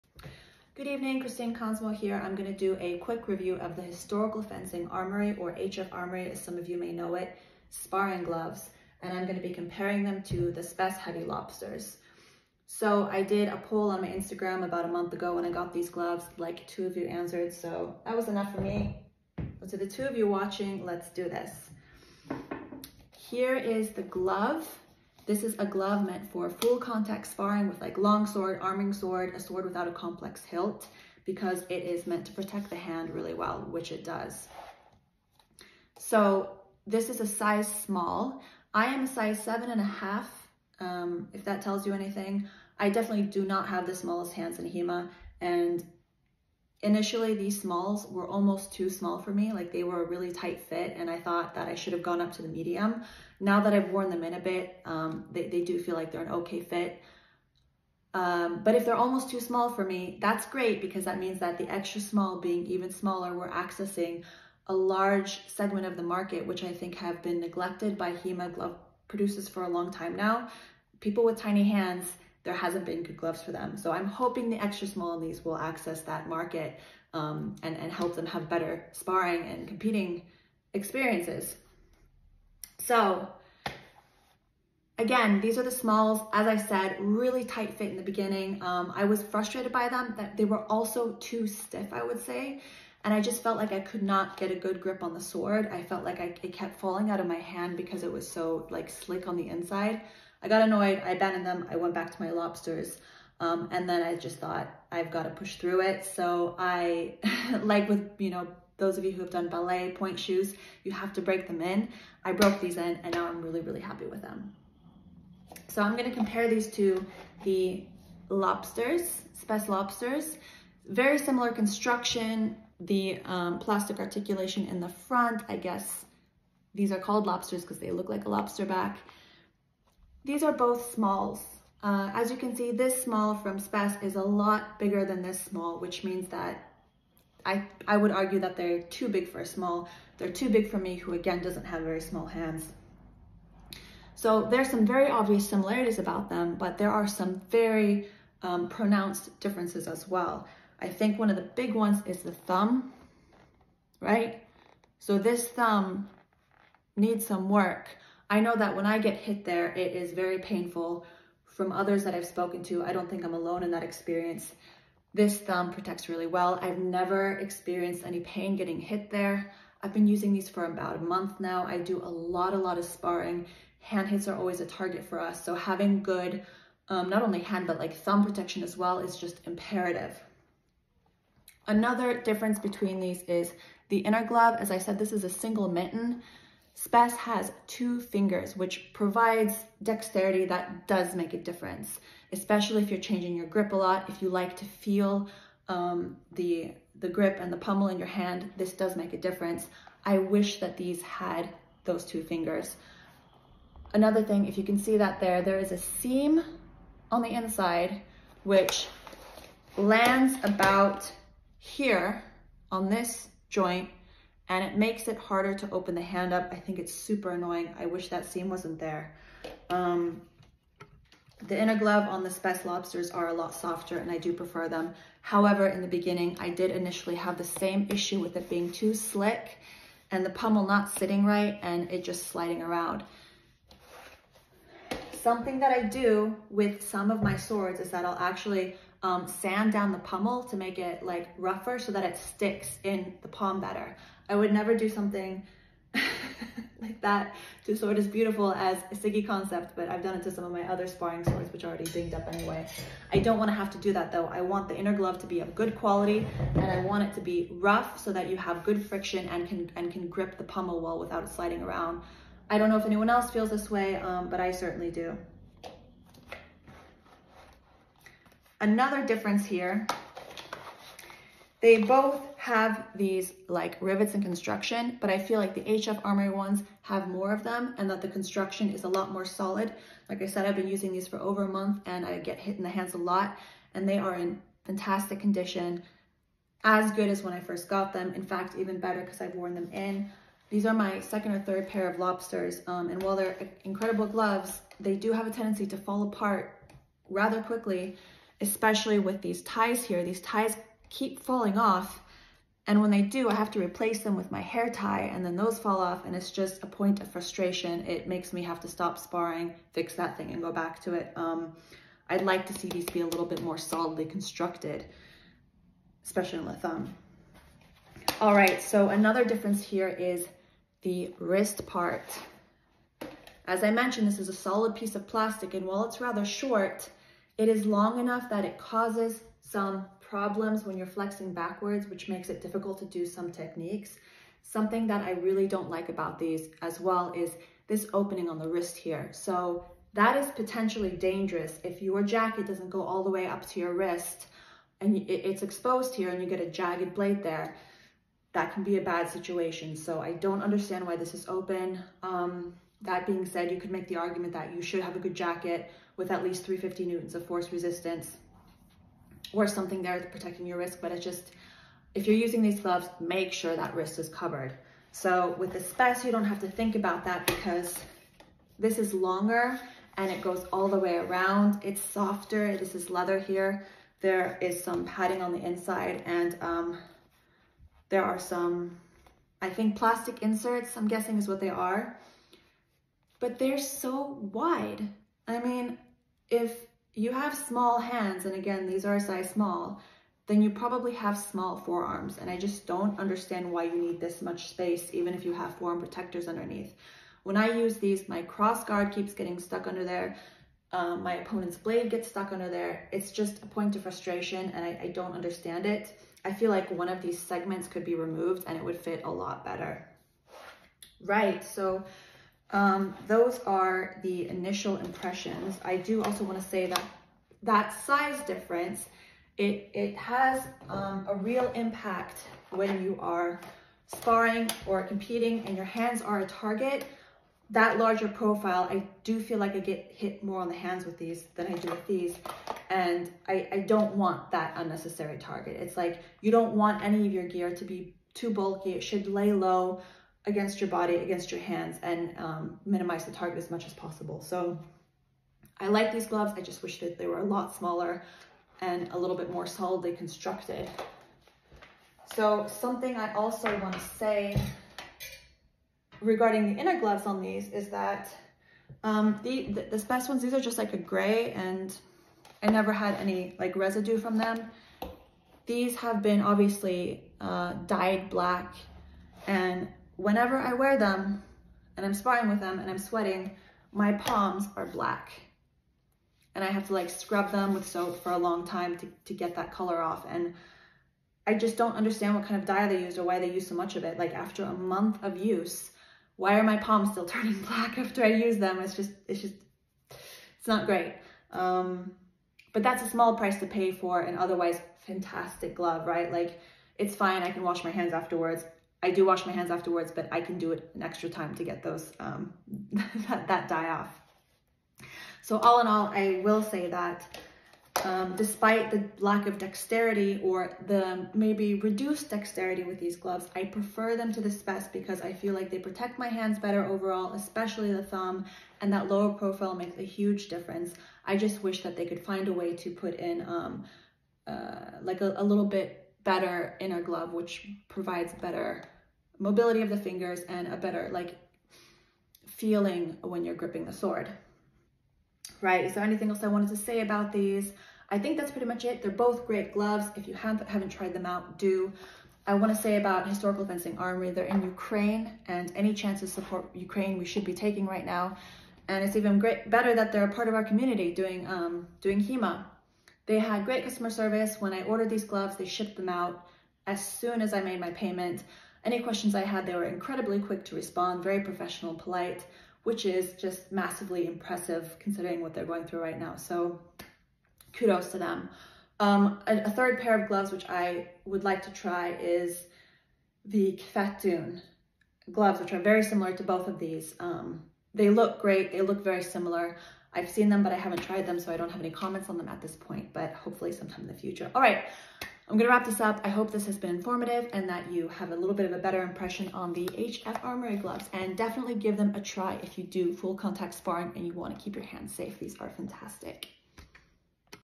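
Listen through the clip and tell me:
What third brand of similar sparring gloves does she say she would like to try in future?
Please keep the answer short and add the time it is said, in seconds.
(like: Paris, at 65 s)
Kvetun, at 573 s.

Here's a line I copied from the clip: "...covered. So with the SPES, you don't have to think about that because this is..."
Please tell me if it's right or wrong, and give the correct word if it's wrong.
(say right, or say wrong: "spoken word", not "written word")
right.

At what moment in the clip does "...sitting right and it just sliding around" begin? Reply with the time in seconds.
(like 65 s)
230 s.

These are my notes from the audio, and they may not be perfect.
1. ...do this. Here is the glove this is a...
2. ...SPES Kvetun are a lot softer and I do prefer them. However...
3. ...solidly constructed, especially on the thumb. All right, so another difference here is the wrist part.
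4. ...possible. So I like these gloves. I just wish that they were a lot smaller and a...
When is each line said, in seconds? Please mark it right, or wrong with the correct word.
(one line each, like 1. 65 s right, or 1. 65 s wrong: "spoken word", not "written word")
1. 21 s right
2. 222 s wrong: "Lobsters", not "Kvetun"
3. 313 s right
4. 443 s right.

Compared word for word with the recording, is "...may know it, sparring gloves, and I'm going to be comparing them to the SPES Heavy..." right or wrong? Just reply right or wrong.
right.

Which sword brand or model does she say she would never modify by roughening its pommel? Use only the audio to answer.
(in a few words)
Siggy concept.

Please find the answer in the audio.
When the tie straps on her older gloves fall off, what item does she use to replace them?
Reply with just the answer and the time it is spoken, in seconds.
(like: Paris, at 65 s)
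hair tie, at 304 s.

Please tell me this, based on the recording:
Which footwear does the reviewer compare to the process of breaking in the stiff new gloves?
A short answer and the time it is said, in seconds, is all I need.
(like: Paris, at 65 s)
ballet pointe shoes, at 109 s.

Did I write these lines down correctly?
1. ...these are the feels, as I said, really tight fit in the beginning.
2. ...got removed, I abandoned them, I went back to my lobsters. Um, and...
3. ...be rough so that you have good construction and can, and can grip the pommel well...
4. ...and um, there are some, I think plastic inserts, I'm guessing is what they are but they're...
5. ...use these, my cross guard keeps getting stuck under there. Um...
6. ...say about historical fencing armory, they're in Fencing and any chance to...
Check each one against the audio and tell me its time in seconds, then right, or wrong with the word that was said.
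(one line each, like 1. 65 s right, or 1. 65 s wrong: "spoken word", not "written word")
1. 85 s wrong: "smalls", not "feels"
2. 100 s wrong: "annoyed", not "removed"
3. 257 s wrong: "friction", not "construction"
4. 376 s right
5. 397 s right
6. 542 s wrong: "Ukraine", not "Fencing".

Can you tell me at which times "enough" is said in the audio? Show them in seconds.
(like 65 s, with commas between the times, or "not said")
18 s, 327 s.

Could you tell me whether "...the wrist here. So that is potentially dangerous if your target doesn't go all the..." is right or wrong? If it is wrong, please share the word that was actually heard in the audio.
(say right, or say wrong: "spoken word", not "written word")
wrong: "jacket", not "target".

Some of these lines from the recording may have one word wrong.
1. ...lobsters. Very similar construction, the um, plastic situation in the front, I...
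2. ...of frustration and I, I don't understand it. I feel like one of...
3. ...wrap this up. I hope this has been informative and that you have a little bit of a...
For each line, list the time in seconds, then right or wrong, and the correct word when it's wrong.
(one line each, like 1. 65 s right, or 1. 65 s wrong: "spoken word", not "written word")
1. 119 s wrong: "articulation", not "situation"
2. 403 s right
3. 585 s right.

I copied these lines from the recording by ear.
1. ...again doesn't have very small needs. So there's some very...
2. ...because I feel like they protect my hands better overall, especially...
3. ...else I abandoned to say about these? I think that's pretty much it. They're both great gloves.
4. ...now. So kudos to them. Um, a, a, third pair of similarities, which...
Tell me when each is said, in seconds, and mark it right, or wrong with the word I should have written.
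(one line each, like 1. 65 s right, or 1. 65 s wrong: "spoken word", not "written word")
1. 141 s wrong: "hands", not "needs"
2. 514 s right
3. 536 s wrong: "wanted", not "abandoned"
4. 565 s wrong: "gloves", not "similarities".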